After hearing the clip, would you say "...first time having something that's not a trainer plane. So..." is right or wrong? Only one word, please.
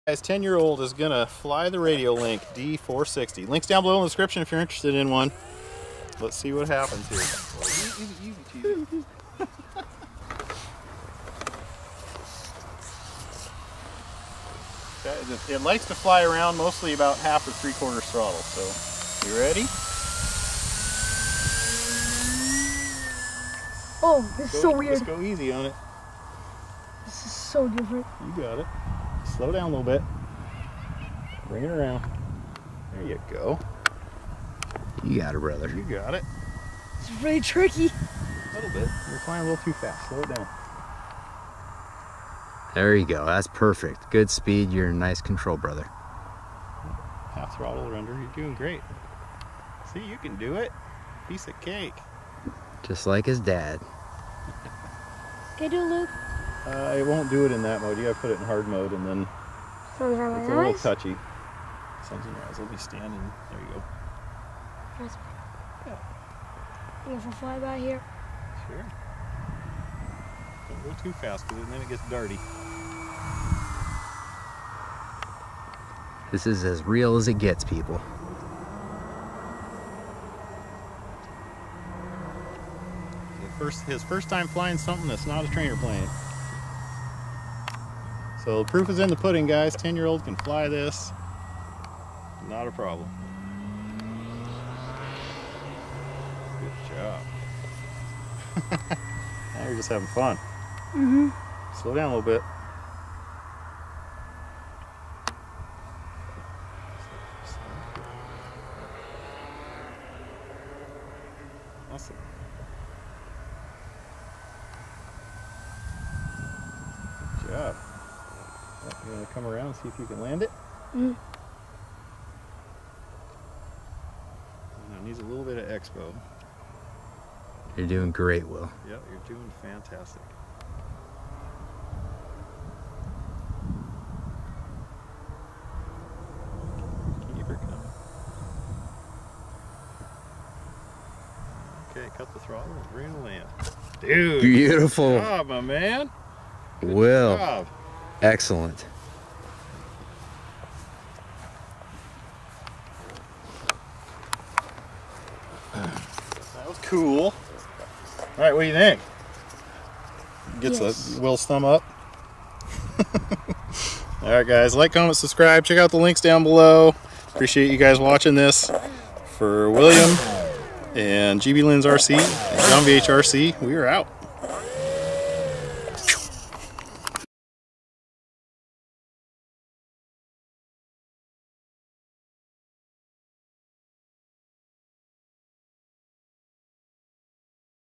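wrong.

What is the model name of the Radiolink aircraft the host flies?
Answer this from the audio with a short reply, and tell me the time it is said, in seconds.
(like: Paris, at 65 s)
D460, at 2 s.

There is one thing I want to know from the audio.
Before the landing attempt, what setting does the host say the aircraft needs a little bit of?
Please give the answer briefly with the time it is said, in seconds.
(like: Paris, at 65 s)
expo, at 125 s.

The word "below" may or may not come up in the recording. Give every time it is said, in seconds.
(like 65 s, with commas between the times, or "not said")
3 s, 166 s.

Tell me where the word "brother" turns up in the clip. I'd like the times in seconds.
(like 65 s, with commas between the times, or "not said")
35 s, 45 s.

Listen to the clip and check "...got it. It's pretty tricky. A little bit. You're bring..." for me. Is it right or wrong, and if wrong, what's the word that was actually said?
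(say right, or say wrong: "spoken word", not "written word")
wrong: "flying", not "bring".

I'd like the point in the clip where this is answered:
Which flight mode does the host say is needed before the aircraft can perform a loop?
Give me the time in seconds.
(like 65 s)
58 s.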